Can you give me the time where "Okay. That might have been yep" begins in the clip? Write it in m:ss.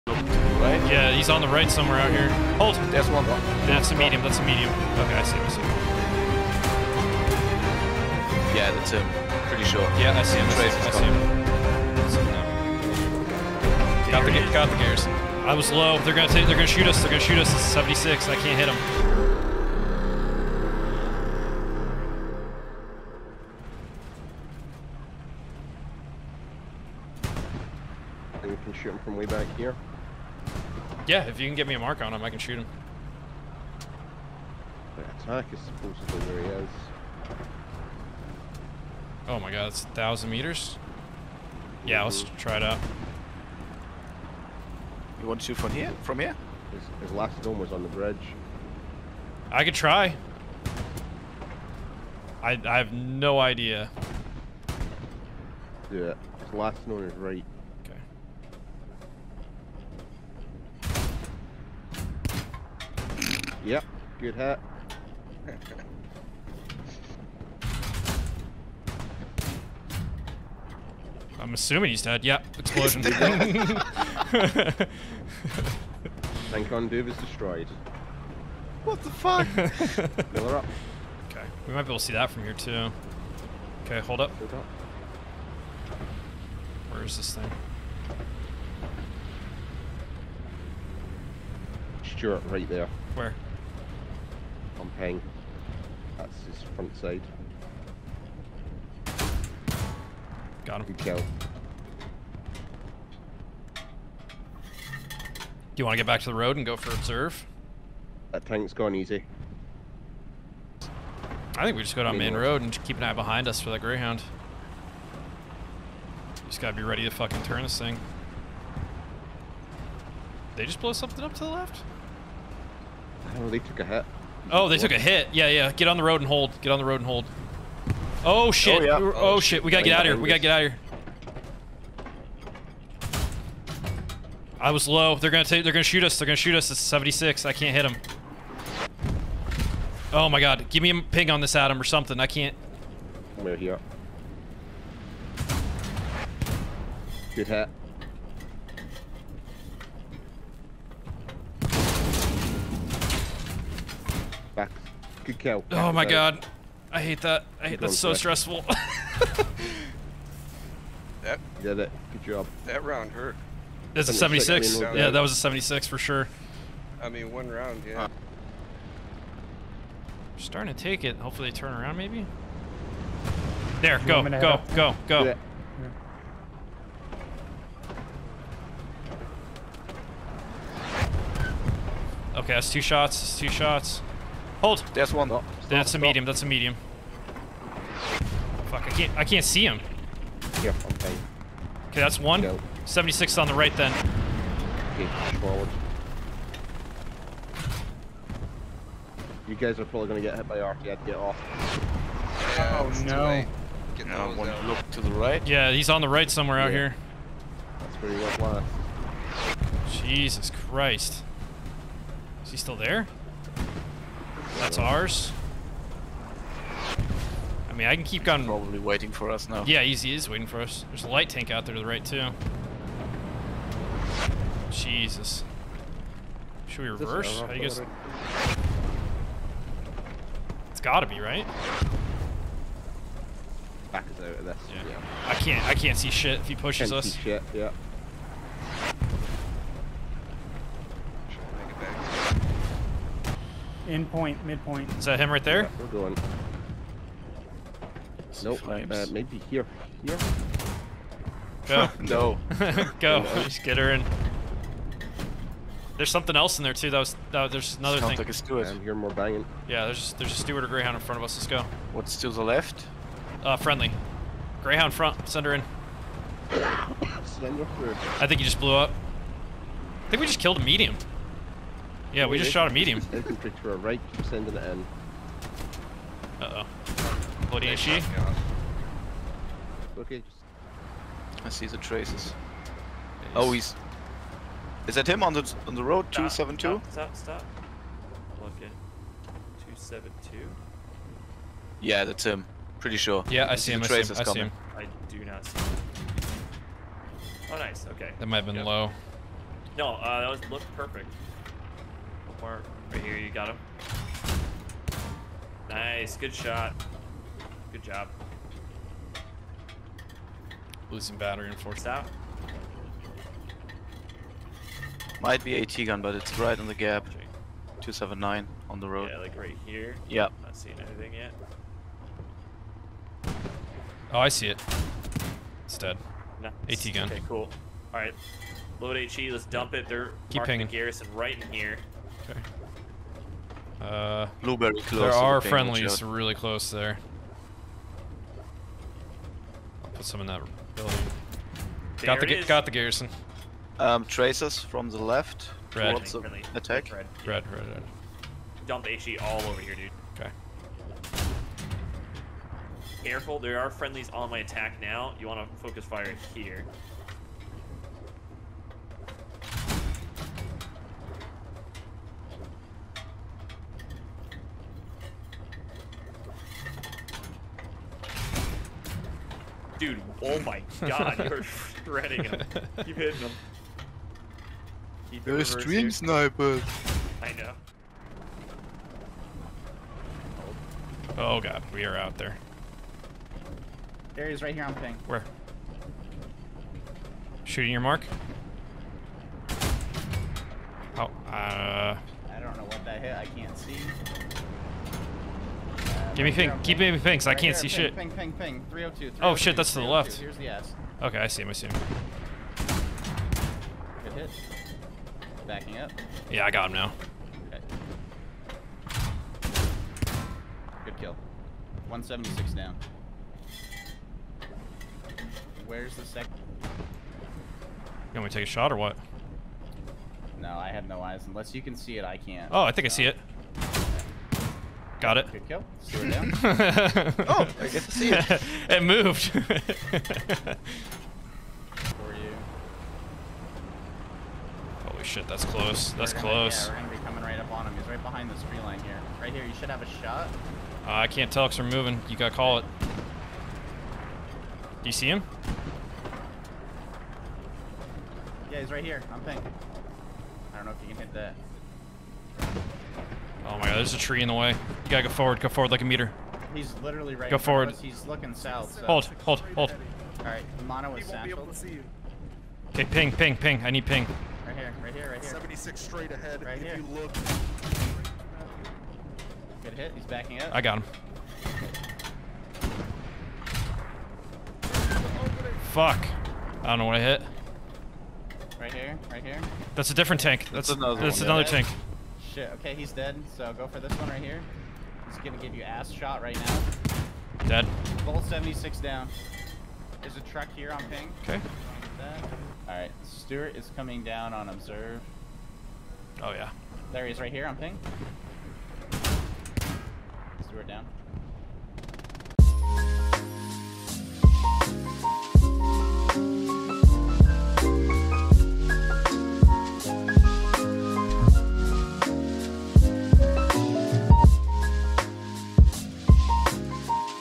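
4:57.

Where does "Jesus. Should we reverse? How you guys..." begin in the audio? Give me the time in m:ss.
3:44.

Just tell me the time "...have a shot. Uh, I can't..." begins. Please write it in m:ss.
7:19.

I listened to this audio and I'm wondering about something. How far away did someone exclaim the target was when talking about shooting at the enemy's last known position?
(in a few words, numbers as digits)
1000 meters.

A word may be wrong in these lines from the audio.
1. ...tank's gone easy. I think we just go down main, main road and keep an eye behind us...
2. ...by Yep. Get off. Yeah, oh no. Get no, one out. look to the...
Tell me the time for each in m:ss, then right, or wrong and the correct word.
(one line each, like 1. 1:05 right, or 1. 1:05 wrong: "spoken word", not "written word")
1. 1:48 right
2. 3:20 wrong: "Arcade", not "Yep".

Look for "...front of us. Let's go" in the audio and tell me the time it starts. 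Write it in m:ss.
4:21.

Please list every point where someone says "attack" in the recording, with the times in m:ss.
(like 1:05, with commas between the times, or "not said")
0:35, 5:46, 5:54.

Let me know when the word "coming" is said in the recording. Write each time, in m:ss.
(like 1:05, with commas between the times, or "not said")
7:17, 8:13.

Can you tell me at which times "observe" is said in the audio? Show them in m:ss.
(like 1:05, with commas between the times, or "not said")
1:46, 8:14.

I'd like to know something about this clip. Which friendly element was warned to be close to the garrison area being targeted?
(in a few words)
Blueberry.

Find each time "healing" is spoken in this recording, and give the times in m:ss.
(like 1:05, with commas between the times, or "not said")
not said.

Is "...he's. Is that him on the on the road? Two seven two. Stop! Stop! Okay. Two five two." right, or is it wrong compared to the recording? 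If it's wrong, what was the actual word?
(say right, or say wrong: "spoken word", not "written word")
wrong: "seven", not "five".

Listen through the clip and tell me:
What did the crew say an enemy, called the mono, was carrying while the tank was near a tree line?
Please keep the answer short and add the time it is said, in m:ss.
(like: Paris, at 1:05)
satchel, at 7:41.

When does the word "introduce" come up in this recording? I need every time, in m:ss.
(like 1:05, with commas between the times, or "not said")
not said.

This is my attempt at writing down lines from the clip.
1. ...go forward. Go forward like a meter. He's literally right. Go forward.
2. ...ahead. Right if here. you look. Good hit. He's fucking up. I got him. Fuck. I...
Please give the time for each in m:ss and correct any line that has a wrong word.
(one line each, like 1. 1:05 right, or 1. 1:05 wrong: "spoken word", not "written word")
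1. 7:34 right
2. 7:46 wrong: "backing", not "fucking".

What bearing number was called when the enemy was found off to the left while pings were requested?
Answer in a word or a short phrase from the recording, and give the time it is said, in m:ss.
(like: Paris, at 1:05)
302, at 6:38.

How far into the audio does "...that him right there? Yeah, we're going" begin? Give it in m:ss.
4:05.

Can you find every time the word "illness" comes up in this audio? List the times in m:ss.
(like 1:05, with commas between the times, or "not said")
not said.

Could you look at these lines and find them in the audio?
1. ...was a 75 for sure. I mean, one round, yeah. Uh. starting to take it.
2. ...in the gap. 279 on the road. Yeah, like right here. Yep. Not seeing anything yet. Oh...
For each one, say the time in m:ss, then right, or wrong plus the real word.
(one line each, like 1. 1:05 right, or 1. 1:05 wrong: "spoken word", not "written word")
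1. 2:45 wrong: "76", not "75"
2. 5:16 right.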